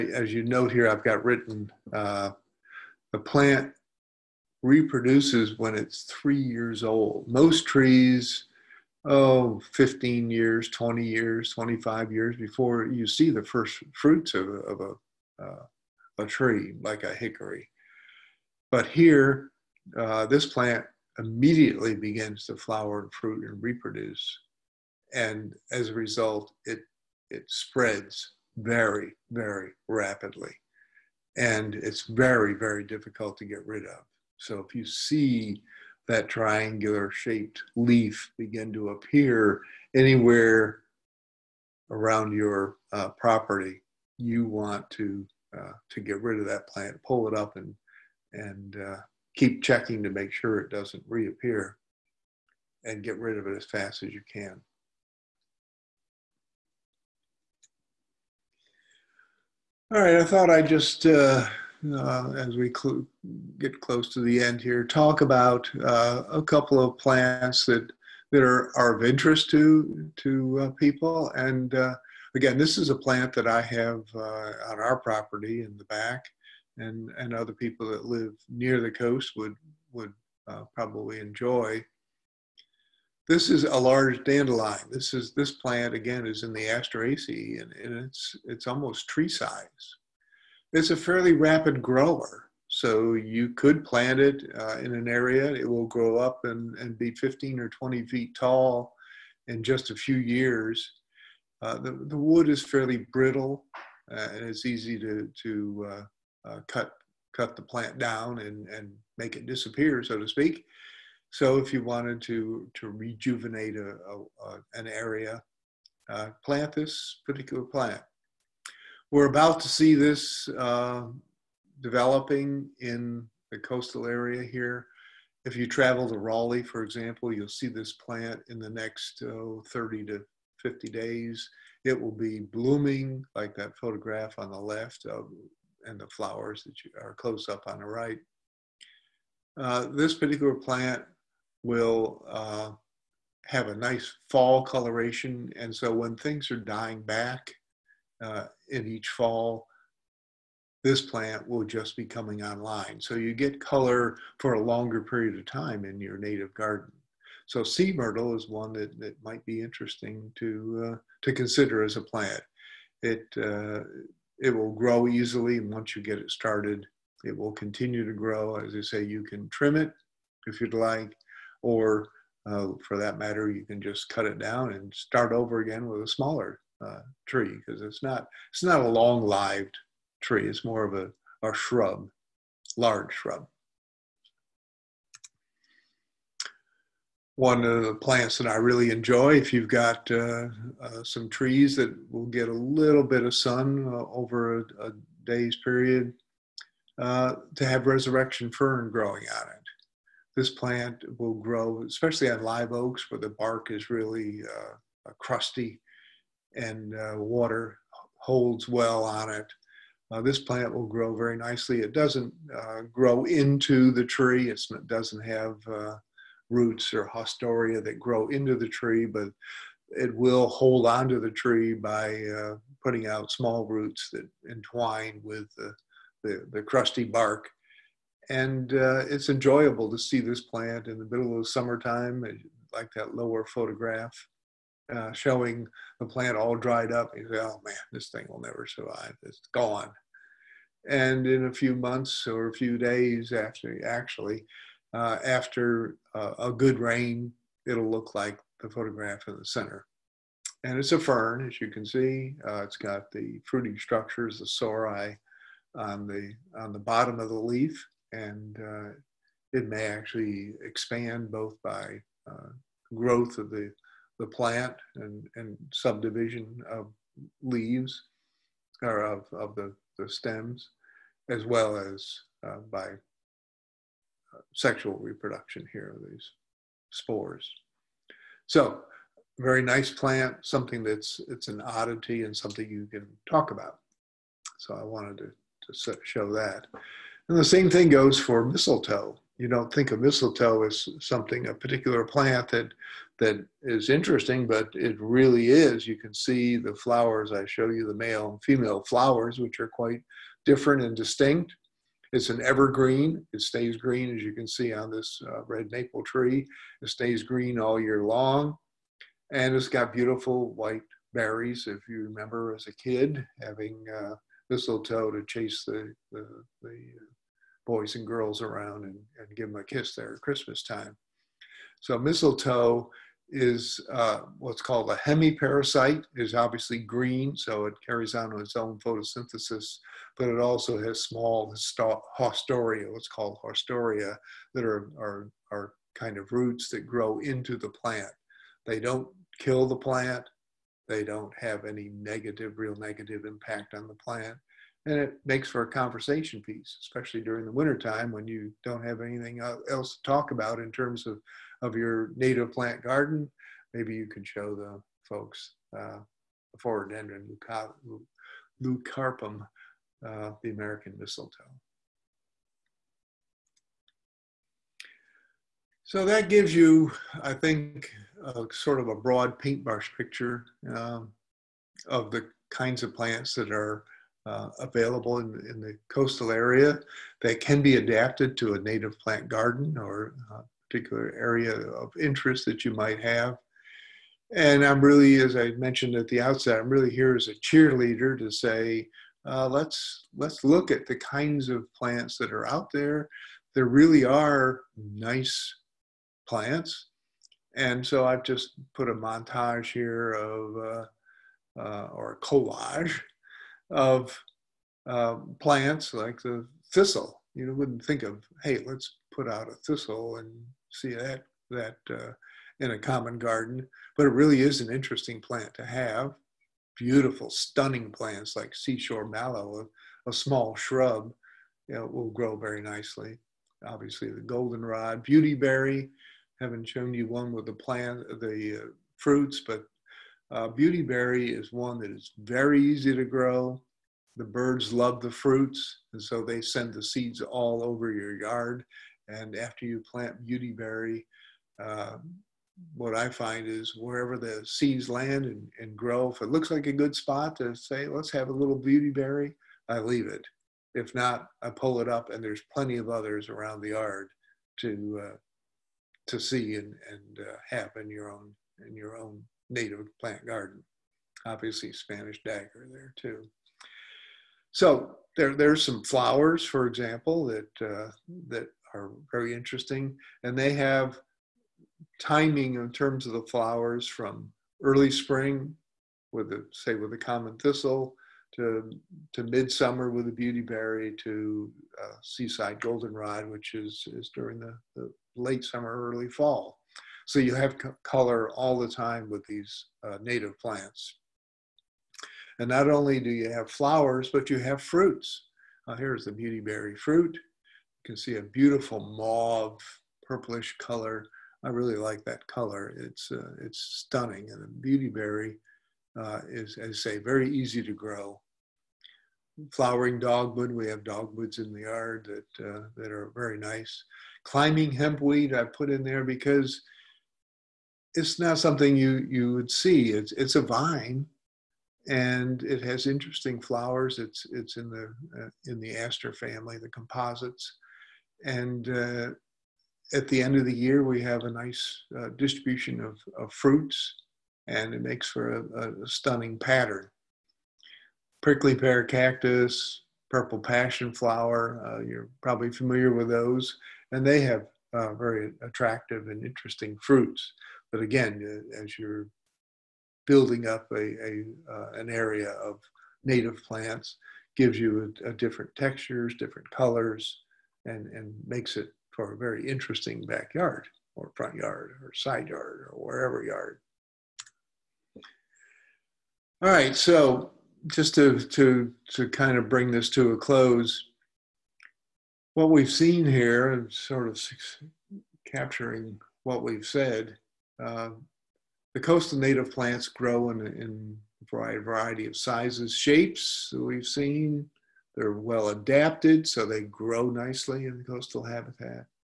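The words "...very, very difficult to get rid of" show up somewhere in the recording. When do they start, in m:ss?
0:32.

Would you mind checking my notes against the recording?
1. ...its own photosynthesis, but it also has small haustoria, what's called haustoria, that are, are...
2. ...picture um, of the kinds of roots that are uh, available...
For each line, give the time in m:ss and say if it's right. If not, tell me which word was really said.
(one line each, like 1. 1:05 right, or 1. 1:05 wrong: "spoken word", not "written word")
1. 5:28 right
2. 6:09 wrong: "plants", not "roots".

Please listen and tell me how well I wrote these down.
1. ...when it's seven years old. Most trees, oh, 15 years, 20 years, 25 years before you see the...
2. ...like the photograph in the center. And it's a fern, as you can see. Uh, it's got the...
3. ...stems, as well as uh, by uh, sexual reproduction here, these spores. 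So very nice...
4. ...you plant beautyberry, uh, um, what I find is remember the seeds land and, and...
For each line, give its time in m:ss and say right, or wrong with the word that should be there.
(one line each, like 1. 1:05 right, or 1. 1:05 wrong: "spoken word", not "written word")
1. 0:05 wrong: "three", not "seven"
2. 4:08 right
3. 4:30 right
4. 7:19 wrong: "wherever", not "remember".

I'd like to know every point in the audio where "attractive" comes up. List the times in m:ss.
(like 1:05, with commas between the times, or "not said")
9:05.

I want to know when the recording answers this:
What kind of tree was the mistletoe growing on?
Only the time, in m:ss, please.
5:05.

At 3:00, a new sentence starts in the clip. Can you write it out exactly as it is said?
It's more of a, a shrub, large shrub.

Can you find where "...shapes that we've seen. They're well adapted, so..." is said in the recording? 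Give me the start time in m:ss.
9:42.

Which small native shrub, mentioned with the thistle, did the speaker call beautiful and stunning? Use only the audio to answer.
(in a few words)
Seashore mallow.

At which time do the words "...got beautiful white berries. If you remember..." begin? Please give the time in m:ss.
5:09.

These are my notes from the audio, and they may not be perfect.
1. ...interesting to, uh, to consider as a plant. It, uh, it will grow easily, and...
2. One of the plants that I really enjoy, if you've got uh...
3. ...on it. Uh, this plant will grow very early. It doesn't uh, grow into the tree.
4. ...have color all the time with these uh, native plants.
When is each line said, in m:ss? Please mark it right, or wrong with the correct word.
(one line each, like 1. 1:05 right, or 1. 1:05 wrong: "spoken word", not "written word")
1. 2:39 right
2. 3:07 right
3. 3:29 wrong: "nicely", not "early"
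4. 8:07 right.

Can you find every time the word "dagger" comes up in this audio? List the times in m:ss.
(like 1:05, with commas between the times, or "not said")
7:42.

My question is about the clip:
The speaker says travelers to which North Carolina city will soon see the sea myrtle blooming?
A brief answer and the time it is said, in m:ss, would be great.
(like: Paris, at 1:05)
Raleigh, at 2:06.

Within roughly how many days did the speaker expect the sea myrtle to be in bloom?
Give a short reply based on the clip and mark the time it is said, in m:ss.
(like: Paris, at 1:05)
30 to 50 days, at 2:09.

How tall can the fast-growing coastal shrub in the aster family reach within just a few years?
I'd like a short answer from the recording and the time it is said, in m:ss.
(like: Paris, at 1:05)
15 or 20 feet, at 1:37.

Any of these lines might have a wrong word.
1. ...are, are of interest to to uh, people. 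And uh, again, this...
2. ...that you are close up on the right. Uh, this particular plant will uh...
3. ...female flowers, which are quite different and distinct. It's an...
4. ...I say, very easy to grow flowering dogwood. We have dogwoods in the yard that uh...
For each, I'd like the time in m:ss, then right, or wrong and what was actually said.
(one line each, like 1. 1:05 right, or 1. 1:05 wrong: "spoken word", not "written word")
1. 1:08 right
2. 2:16 right
3. 4:58 right
4. 8:26 right.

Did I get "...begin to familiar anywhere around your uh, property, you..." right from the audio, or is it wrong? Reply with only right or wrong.
wrong.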